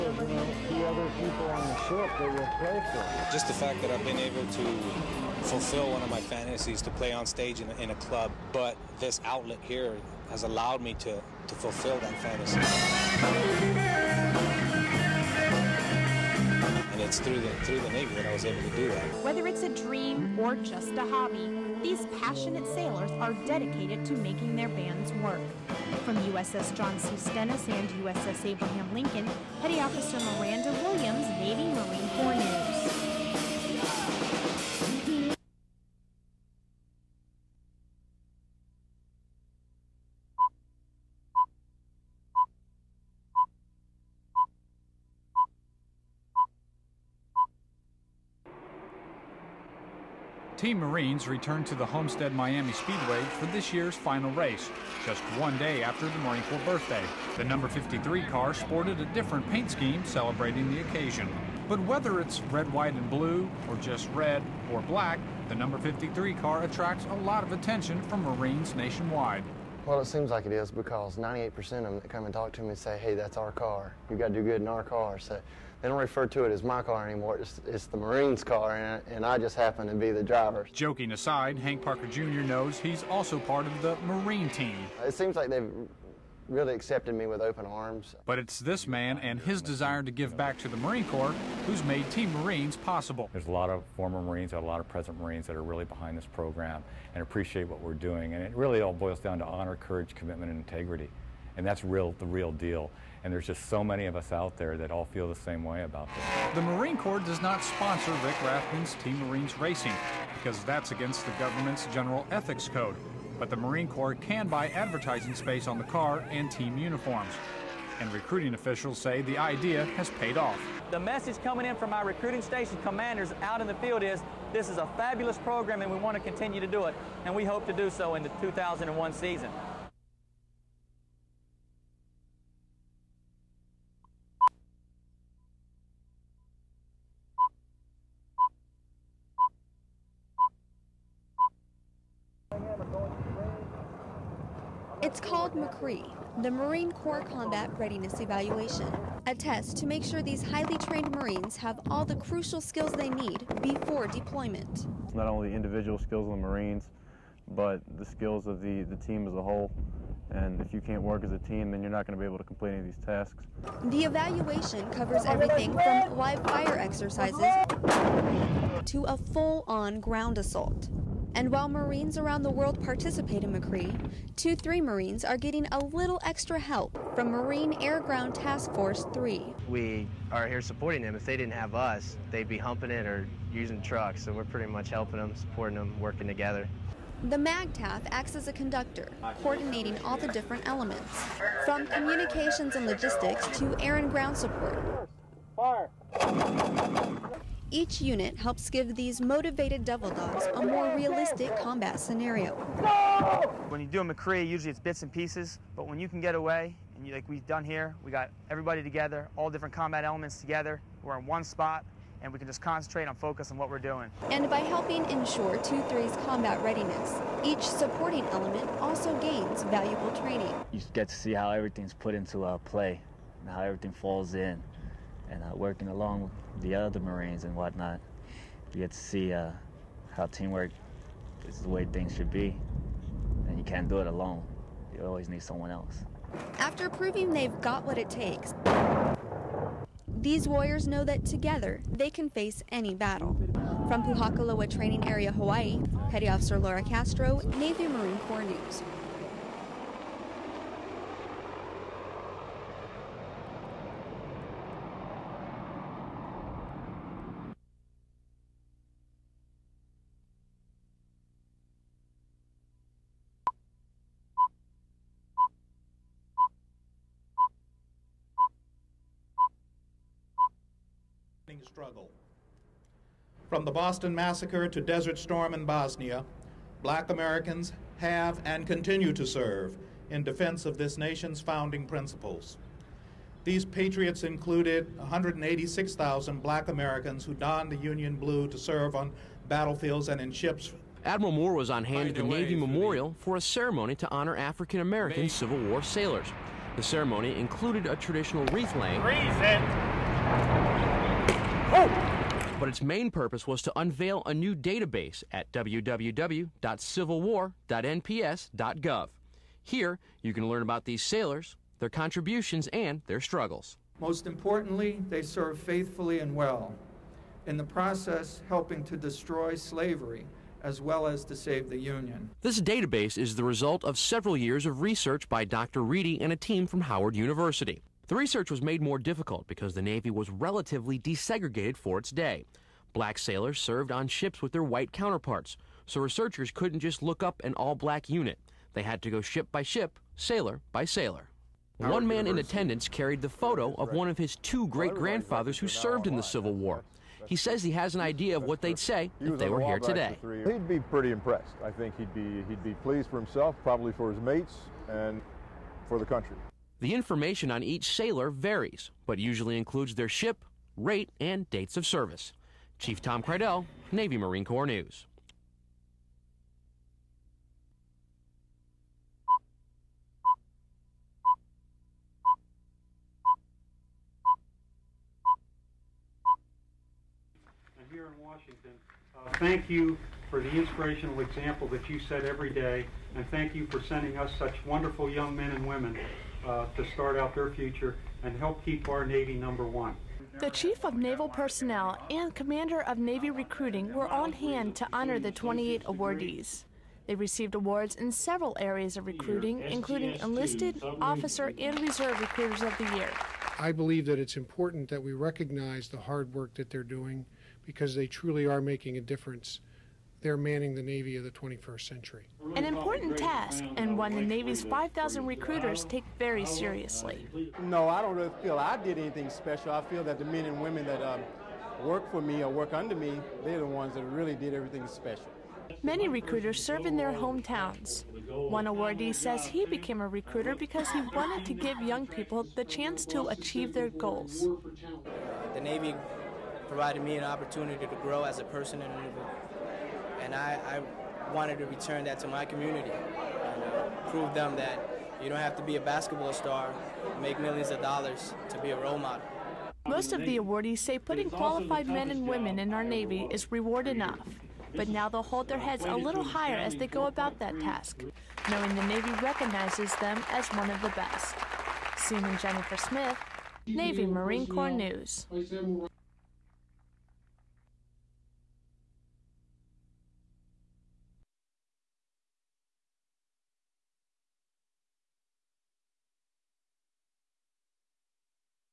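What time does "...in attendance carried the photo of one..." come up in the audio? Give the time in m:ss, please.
5:42.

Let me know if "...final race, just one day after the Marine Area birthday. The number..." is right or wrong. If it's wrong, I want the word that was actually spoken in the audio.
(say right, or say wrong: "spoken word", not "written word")
wrong: "Corps", not "Area".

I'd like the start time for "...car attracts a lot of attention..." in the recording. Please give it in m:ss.
1:06.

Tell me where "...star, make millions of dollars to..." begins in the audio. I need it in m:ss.
7:26.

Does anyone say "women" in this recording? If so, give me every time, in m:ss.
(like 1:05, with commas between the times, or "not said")
6:25, 7:00, 7:32.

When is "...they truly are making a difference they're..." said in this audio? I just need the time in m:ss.
6:47.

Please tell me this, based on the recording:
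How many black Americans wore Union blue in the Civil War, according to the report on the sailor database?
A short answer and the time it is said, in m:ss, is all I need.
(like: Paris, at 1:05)
186,000, at 4:44.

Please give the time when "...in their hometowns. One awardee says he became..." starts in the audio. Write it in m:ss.
7:06.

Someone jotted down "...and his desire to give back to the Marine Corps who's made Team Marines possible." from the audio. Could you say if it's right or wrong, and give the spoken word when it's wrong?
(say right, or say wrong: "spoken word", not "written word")
right.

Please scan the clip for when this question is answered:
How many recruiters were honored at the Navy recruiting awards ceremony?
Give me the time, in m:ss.
6:35.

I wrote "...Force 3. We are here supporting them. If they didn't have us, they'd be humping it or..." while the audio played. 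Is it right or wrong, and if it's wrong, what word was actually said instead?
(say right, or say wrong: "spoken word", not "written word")
right.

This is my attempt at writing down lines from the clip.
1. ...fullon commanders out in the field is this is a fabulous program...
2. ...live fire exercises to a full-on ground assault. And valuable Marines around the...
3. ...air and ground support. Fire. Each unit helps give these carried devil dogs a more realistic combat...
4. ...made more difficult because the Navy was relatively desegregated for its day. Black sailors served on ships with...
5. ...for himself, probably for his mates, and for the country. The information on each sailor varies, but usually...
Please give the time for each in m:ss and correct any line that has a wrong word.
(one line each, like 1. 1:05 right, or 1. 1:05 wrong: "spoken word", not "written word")
1. 2:02 wrong: "station", not "fullon"
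2. 2:46 wrong: "while", not "valuable"
3. 3:13 wrong: "motivated", not "carried"
4. 5:28 right
5. 5:53 right.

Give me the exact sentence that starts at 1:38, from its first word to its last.
And it really all boils down to honor, courage, commitment, and integrity.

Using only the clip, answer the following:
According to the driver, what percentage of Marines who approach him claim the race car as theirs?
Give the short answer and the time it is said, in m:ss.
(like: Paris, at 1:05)
98%, at 1:11.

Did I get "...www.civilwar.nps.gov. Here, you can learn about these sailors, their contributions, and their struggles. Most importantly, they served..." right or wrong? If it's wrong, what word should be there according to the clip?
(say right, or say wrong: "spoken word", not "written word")
right.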